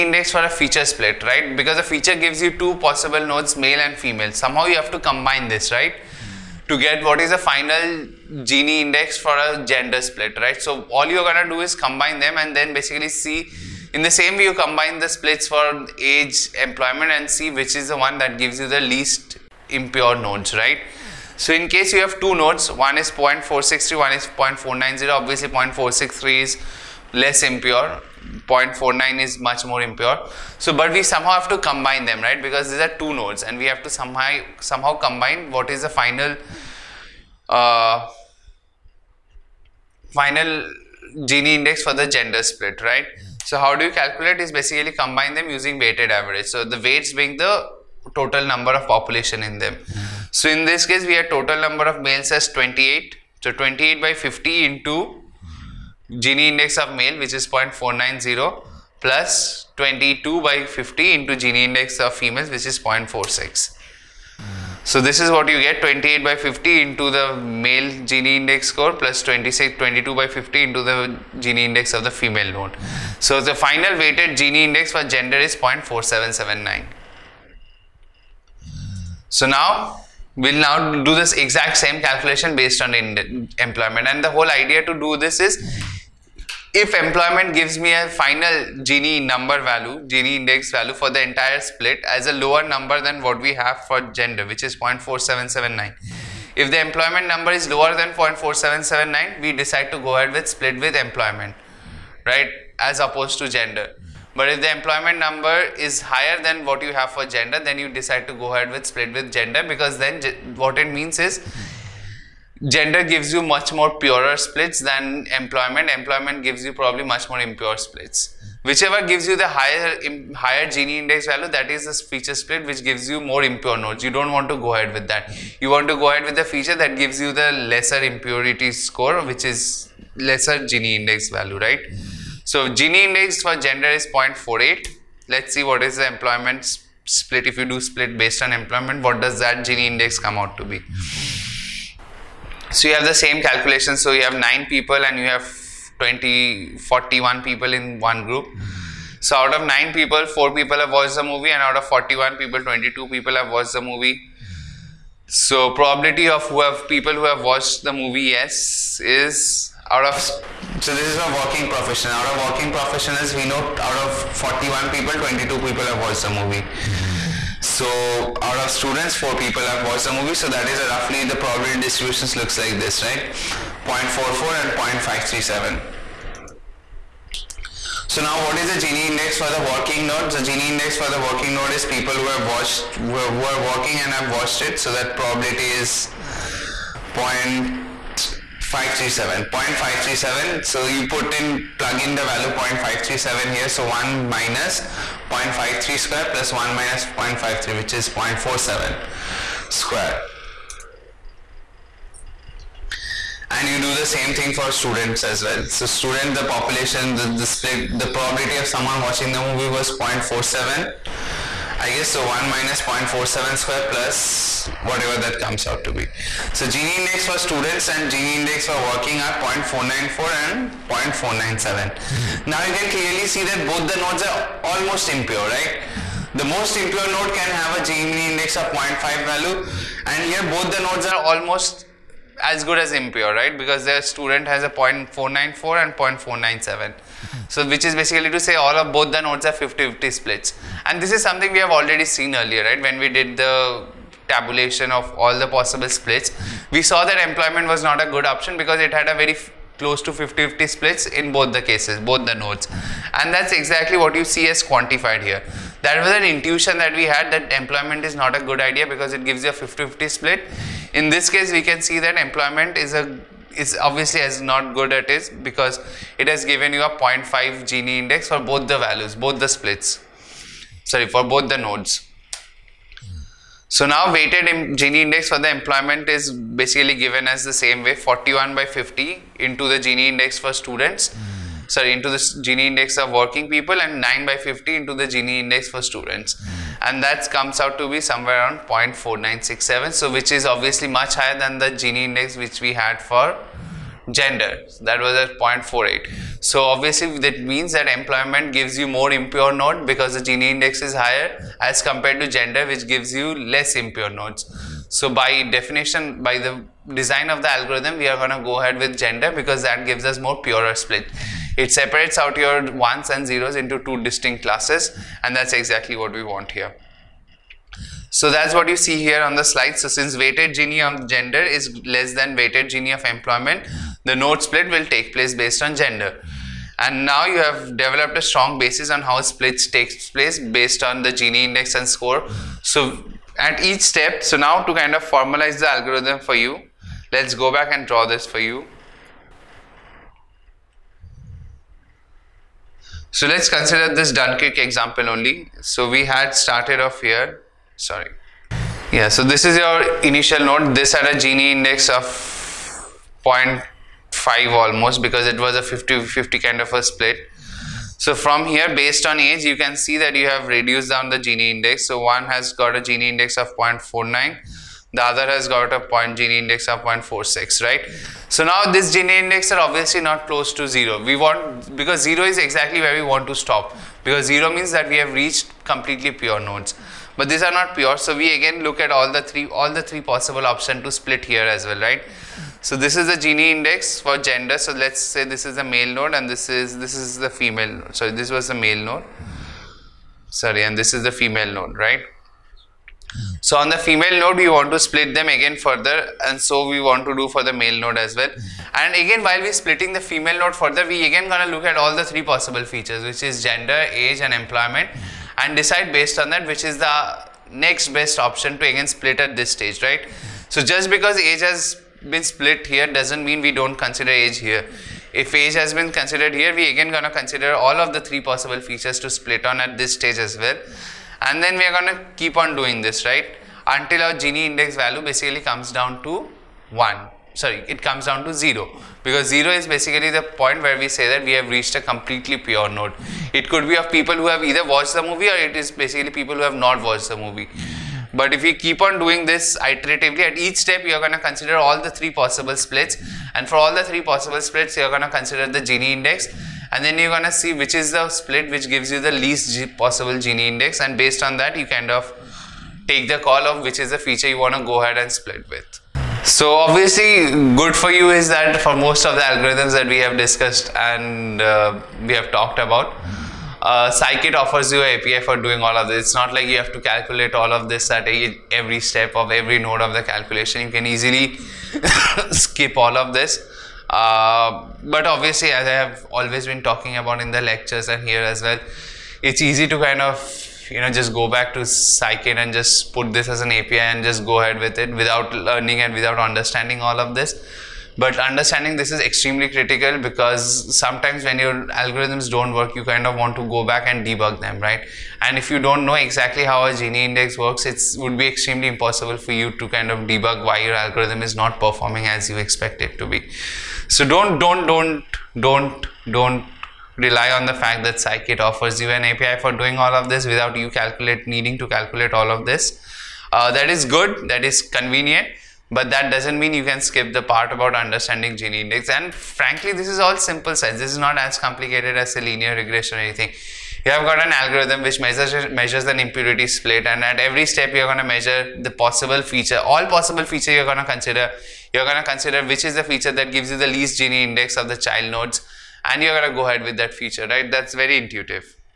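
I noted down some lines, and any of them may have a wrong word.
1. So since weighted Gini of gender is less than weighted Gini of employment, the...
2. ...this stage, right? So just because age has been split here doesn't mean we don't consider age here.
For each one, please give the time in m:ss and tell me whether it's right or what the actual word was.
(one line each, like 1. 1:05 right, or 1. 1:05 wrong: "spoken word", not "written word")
1. 5:19 right
2. 6:49 right.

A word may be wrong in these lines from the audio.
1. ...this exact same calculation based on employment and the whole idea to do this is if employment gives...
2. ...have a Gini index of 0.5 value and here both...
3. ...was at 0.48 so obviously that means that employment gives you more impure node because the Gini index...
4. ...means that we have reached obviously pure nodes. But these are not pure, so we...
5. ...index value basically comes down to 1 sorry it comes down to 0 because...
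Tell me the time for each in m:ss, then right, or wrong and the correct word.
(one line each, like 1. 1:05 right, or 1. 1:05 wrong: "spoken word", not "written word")
1. 1:21 right
2. 3:47 right
3. 4:55 right
4. 6:14 wrong: "completely", not "obviously"
5. 7:04 right.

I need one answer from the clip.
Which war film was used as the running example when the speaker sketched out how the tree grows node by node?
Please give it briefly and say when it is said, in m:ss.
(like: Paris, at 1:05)
Dunkirk, at 5:44.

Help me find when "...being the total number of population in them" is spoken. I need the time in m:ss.
0:47.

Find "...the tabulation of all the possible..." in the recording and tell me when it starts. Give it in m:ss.
4:03.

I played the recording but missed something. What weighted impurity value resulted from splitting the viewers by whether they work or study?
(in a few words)
0.4967.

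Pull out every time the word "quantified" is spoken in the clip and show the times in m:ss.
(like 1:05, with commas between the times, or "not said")
4:14.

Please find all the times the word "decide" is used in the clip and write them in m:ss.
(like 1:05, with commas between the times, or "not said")
1:39, 1:47, 6:45.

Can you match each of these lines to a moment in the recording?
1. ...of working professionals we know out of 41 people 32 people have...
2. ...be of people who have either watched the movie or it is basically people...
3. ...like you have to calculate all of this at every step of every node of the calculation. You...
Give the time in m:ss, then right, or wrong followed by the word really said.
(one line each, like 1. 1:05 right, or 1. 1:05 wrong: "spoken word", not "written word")
1. 2:42 wrong: "22", not "32"
2. 7:13 right
3. 7:46 right.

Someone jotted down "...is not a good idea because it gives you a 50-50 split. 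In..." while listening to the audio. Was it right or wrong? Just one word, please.
right.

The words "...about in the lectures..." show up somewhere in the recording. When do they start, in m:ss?
7:56.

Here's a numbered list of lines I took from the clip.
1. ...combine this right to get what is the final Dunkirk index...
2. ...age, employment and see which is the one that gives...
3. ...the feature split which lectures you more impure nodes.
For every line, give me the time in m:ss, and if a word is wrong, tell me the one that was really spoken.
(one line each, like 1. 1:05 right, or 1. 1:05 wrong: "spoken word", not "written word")
1. 0:04 wrong: "Gini", not "Dunkirk"
2. 0:15 right
3. 2:01 wrong: "gives", not "lectures".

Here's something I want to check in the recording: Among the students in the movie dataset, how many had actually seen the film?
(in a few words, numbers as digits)
4.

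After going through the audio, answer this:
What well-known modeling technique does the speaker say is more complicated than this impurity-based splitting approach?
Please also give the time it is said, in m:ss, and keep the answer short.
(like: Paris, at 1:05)
linear regression, at 8:42.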